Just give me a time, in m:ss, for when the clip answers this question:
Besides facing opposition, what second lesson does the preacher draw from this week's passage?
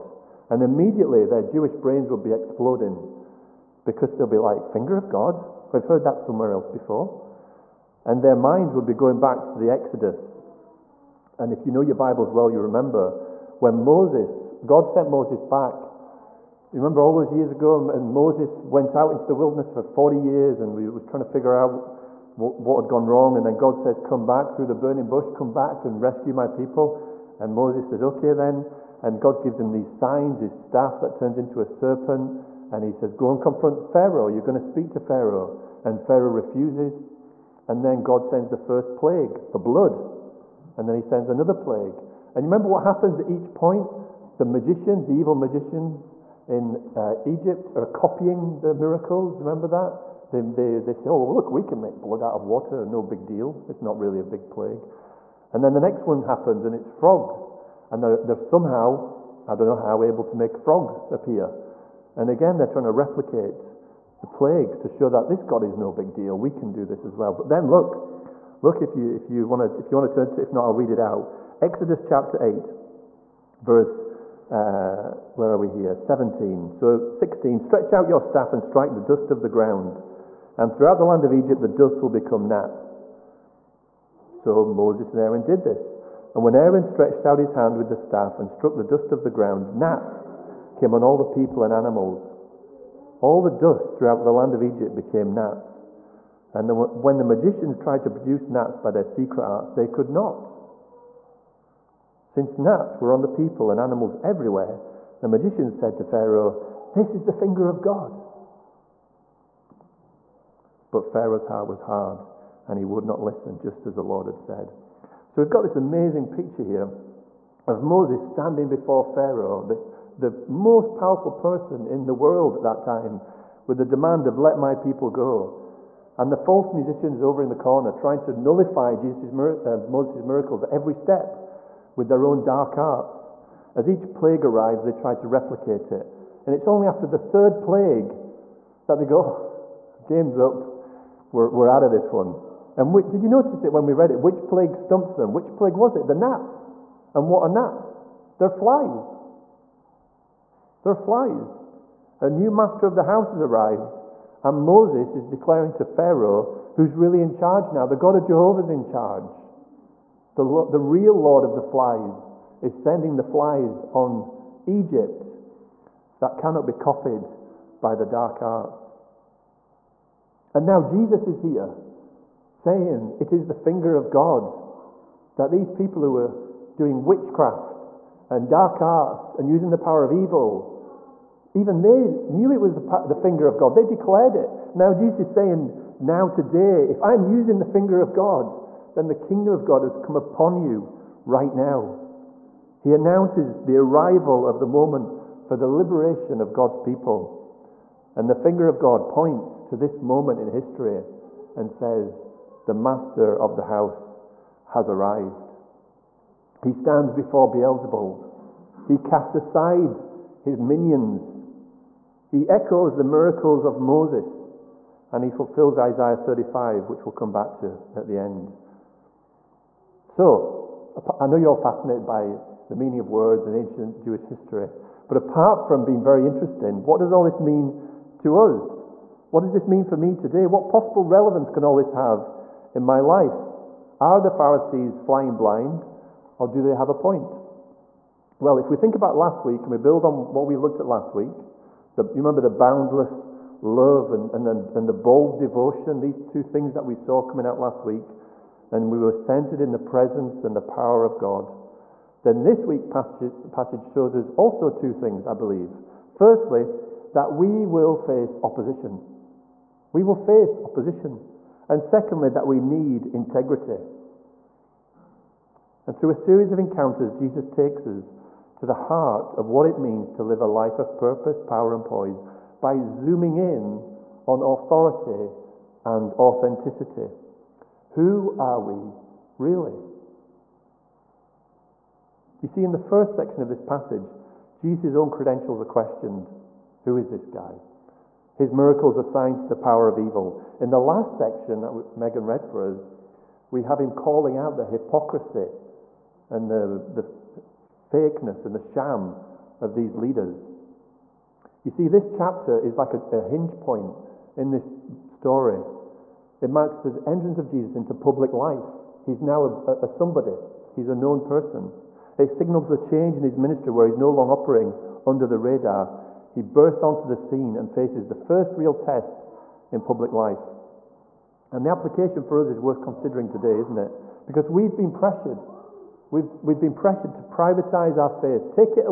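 4:23.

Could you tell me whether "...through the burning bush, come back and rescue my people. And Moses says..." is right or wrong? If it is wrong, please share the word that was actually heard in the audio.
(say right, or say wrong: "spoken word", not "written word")
right.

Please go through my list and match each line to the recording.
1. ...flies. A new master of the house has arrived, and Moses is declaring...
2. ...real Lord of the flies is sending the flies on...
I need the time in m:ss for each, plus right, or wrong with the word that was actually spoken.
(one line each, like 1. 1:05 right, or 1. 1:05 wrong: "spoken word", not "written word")
1. 2:30 right
2. 2:40 right.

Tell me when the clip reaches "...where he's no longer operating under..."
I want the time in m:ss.
5:13.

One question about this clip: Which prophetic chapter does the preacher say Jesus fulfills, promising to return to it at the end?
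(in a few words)
Isaiah 35.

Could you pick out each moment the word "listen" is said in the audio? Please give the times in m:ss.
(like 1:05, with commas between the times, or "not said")
1:53.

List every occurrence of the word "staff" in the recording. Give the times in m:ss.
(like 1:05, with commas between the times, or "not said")
0:30, 1:18, 1:27.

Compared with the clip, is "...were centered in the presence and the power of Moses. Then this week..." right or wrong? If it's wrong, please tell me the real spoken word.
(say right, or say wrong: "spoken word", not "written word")
wrong: "God", not "Moses".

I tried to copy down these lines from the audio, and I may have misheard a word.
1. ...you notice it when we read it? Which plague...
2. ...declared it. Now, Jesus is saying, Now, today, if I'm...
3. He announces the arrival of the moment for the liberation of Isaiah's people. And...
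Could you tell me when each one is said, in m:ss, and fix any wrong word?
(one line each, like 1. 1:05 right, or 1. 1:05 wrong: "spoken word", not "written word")
1. 2:23 right
2. 3:03 right
3. 3:12 wrong: "God", not "Isaiah".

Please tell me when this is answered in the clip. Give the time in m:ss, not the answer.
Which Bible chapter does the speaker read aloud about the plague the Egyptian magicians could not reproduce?
1:11.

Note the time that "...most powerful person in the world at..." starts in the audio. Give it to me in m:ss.
2:00.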